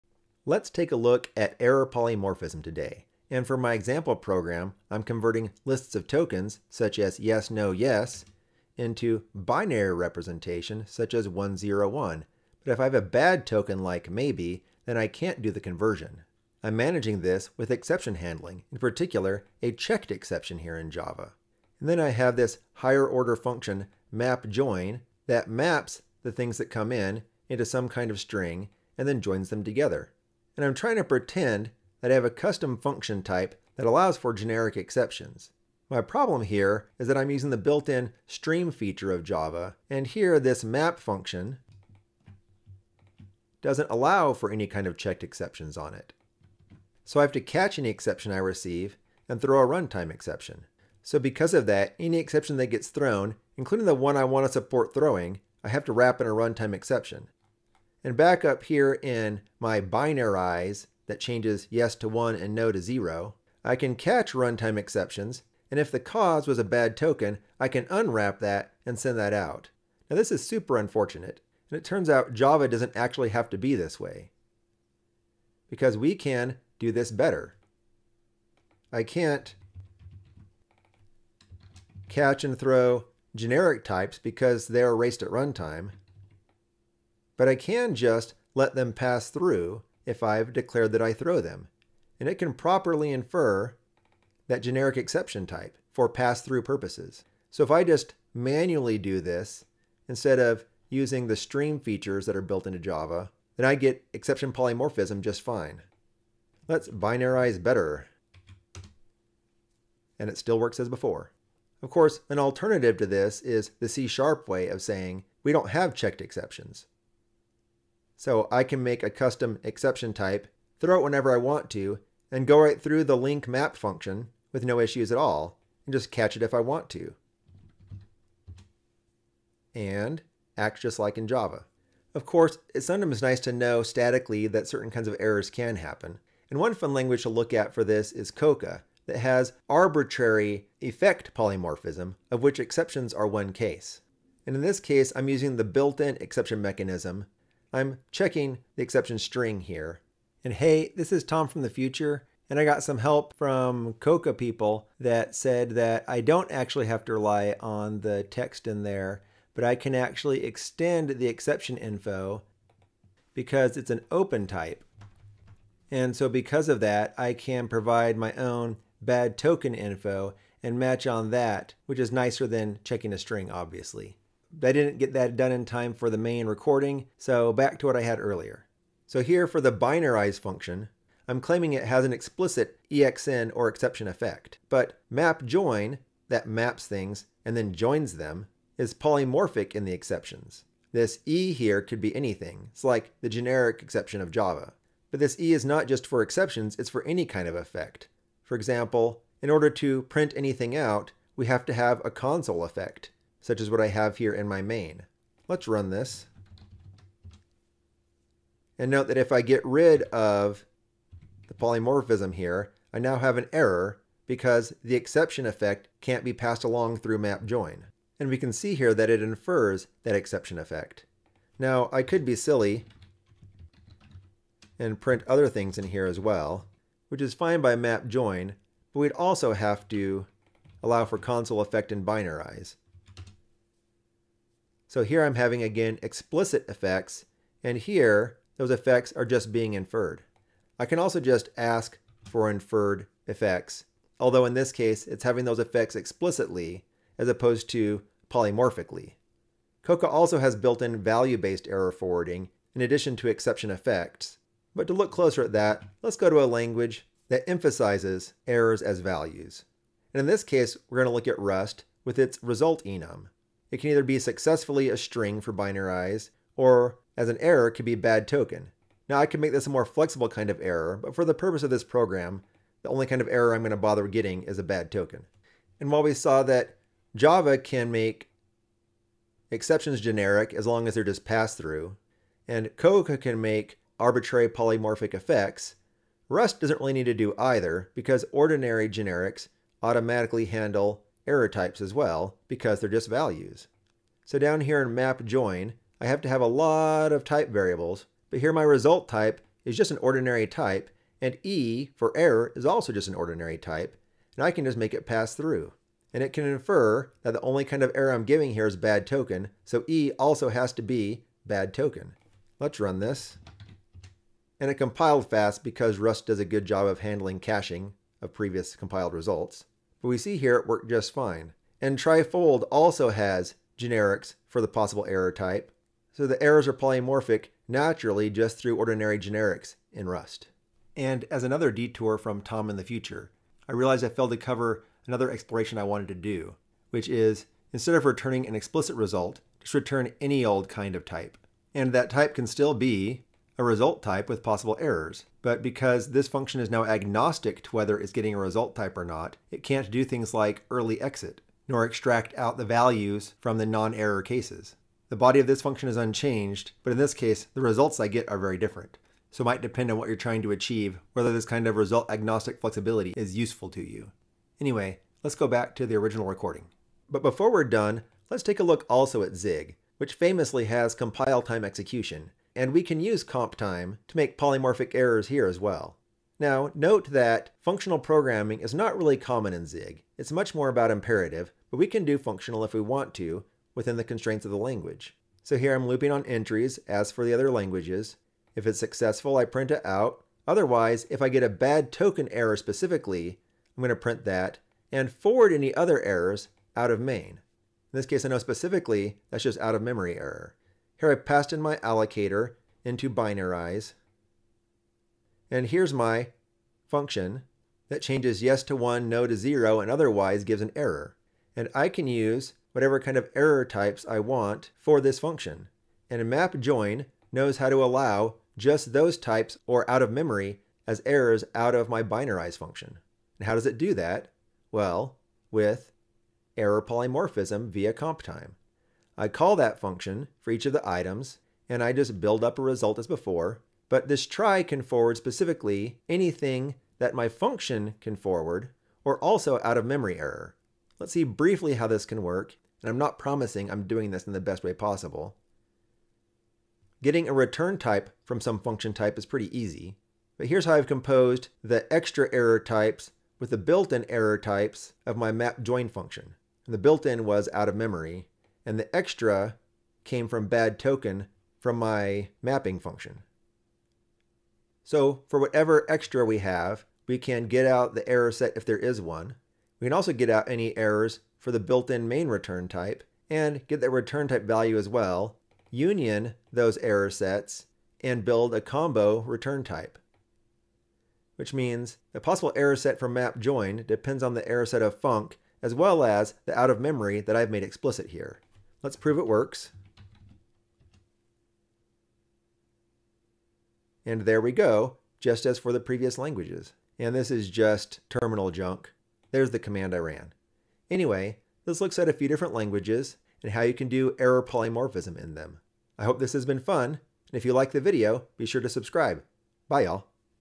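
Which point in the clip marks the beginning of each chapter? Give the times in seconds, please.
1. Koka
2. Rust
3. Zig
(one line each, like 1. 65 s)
1. 136 s
2. 249 s
3. 367 s.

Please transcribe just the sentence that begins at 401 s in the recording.
Here I passed in my allocator into binarize.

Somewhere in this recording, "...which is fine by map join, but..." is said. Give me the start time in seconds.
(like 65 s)
227 s.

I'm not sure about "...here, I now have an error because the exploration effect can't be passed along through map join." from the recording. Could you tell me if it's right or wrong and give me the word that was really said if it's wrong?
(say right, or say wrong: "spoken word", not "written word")
wrong: "exception", not "exploration".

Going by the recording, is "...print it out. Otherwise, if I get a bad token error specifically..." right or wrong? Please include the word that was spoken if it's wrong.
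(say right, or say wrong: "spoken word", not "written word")
right.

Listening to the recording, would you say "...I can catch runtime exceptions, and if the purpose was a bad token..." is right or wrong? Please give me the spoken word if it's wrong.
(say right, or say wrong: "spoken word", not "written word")
wrong: "cause", not "purpose".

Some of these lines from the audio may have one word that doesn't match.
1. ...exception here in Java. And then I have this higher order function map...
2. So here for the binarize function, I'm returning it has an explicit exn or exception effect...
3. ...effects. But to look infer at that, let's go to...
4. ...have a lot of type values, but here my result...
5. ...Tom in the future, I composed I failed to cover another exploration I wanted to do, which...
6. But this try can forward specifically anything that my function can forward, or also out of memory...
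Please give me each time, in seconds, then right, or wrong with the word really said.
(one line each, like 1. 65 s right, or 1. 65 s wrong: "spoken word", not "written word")
1. 20 s right
2. 179 s wrong: "claiming", not "returning"
3. 253 s wrong: "closer", not "infer"
4. 296 s wrong: "variables", not "values"
5. 332 s wrong: "realized", not "composed"
6. 433 s right.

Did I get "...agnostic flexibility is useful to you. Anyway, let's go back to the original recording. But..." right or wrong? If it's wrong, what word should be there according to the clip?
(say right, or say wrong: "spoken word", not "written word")
right.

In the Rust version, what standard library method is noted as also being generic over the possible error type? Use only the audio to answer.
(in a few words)
try_fold.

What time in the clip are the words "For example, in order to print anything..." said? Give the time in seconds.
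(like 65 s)
198 s.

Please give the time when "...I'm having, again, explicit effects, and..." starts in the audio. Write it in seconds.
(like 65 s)
235 s.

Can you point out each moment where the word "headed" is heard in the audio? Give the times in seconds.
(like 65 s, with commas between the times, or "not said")
not said.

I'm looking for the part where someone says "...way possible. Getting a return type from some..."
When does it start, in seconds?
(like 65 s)
444 s.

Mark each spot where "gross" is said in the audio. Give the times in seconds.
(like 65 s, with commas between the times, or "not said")
not said.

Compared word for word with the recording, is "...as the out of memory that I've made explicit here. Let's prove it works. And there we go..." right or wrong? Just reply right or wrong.
right.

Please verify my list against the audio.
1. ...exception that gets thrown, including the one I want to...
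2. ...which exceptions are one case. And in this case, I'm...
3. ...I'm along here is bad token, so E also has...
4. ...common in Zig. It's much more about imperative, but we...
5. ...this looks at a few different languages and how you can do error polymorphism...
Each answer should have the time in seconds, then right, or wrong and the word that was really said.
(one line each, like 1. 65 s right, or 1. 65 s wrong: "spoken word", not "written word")
1. 52 s right
2. 142 s right
3. 308 s wrong: "giving", not "along"
4. 379 s right
5. 501 s right.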